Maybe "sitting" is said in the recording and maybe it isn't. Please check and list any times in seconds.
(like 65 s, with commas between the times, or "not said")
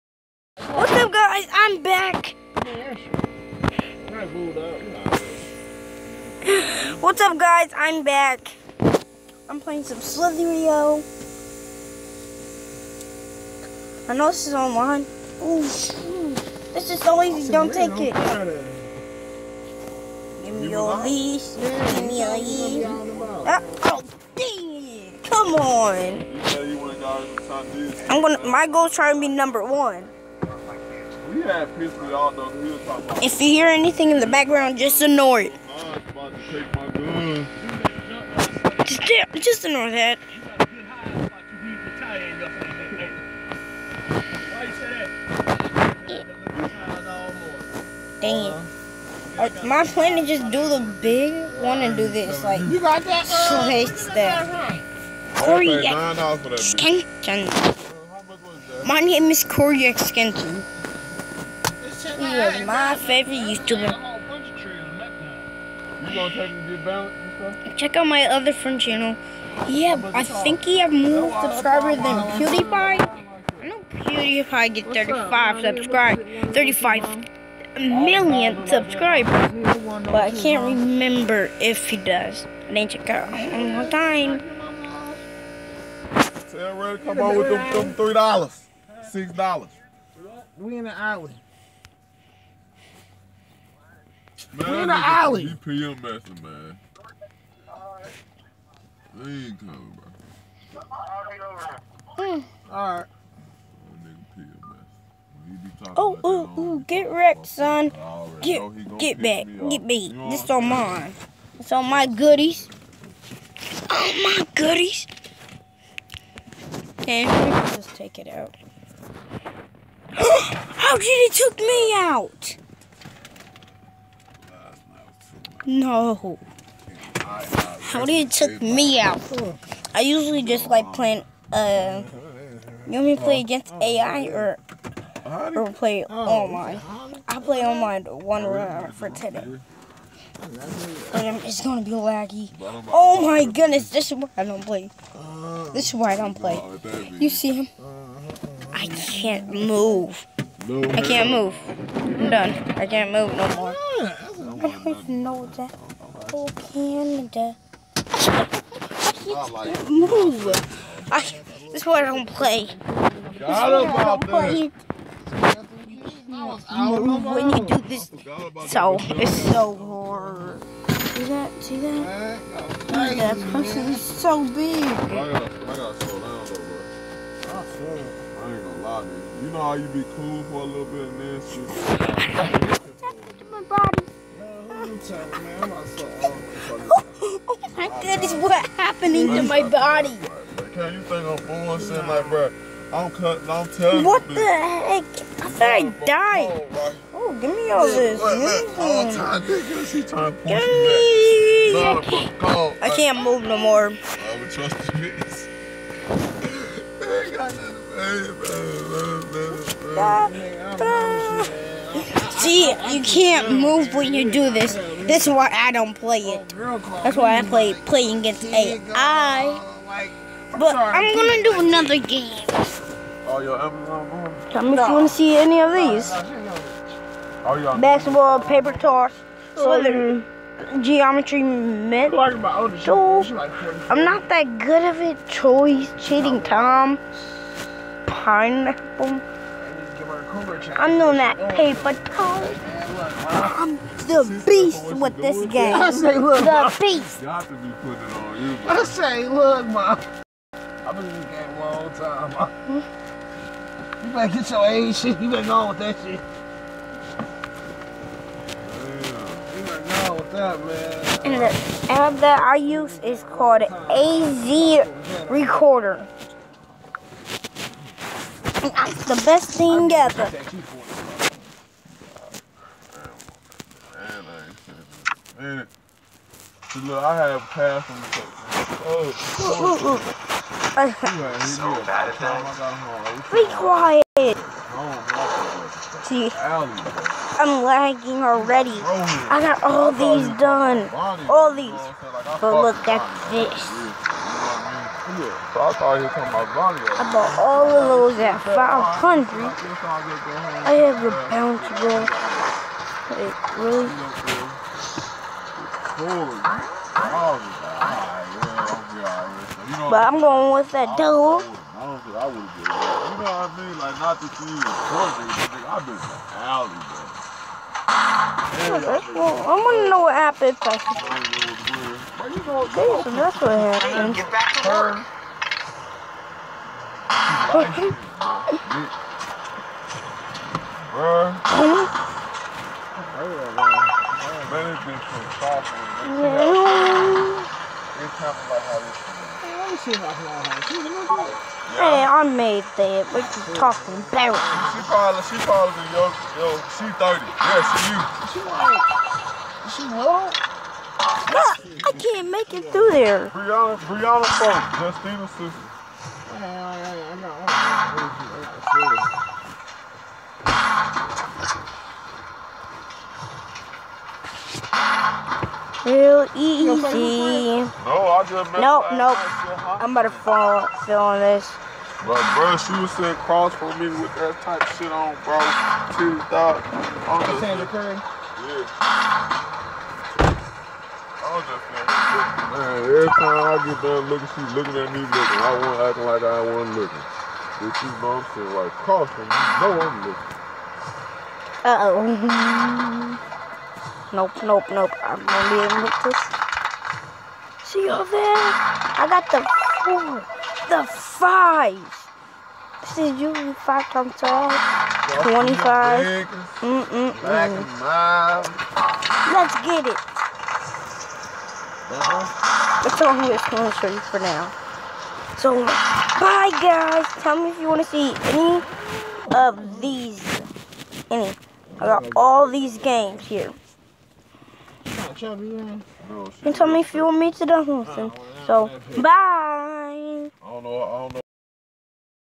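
372 s, 388 s.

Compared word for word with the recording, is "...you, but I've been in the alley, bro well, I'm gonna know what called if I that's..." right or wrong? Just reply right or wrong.
wrong.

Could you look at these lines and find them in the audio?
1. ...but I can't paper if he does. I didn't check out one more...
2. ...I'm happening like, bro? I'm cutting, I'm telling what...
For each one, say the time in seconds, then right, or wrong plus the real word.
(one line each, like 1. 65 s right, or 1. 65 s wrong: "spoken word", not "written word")
1. 80 s wrong: "remember", not "paper"
2. 191 s wrong: "fooling", not "happening".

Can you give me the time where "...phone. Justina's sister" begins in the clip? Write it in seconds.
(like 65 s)
354 s.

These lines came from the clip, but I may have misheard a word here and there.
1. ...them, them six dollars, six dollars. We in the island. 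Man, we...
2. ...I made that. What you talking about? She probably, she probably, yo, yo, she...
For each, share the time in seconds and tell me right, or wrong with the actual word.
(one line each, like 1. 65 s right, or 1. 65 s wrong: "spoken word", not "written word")
1. 87 s wrong: "three", not "six"
2. 342 s right.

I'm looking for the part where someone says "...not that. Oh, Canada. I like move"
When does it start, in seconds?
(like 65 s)
155 s.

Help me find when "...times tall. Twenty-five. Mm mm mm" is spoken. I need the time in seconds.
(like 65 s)
403 s.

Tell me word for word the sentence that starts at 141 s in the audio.
And um, it's gonna be laggy.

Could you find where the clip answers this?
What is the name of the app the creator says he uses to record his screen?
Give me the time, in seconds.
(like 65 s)
263 s.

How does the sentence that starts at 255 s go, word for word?
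You better go on with that shit.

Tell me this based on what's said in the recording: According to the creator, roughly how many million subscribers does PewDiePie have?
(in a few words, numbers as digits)
35 million.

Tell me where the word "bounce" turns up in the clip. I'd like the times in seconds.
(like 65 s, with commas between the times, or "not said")
301 s.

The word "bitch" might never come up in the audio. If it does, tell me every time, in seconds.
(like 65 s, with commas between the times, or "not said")
204 s.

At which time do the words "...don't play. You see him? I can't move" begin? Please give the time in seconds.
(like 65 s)
146 s.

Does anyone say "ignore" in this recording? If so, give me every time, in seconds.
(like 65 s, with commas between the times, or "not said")
35 s, 39 s.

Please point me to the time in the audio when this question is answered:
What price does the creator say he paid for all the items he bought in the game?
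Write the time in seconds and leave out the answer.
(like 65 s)
298 s.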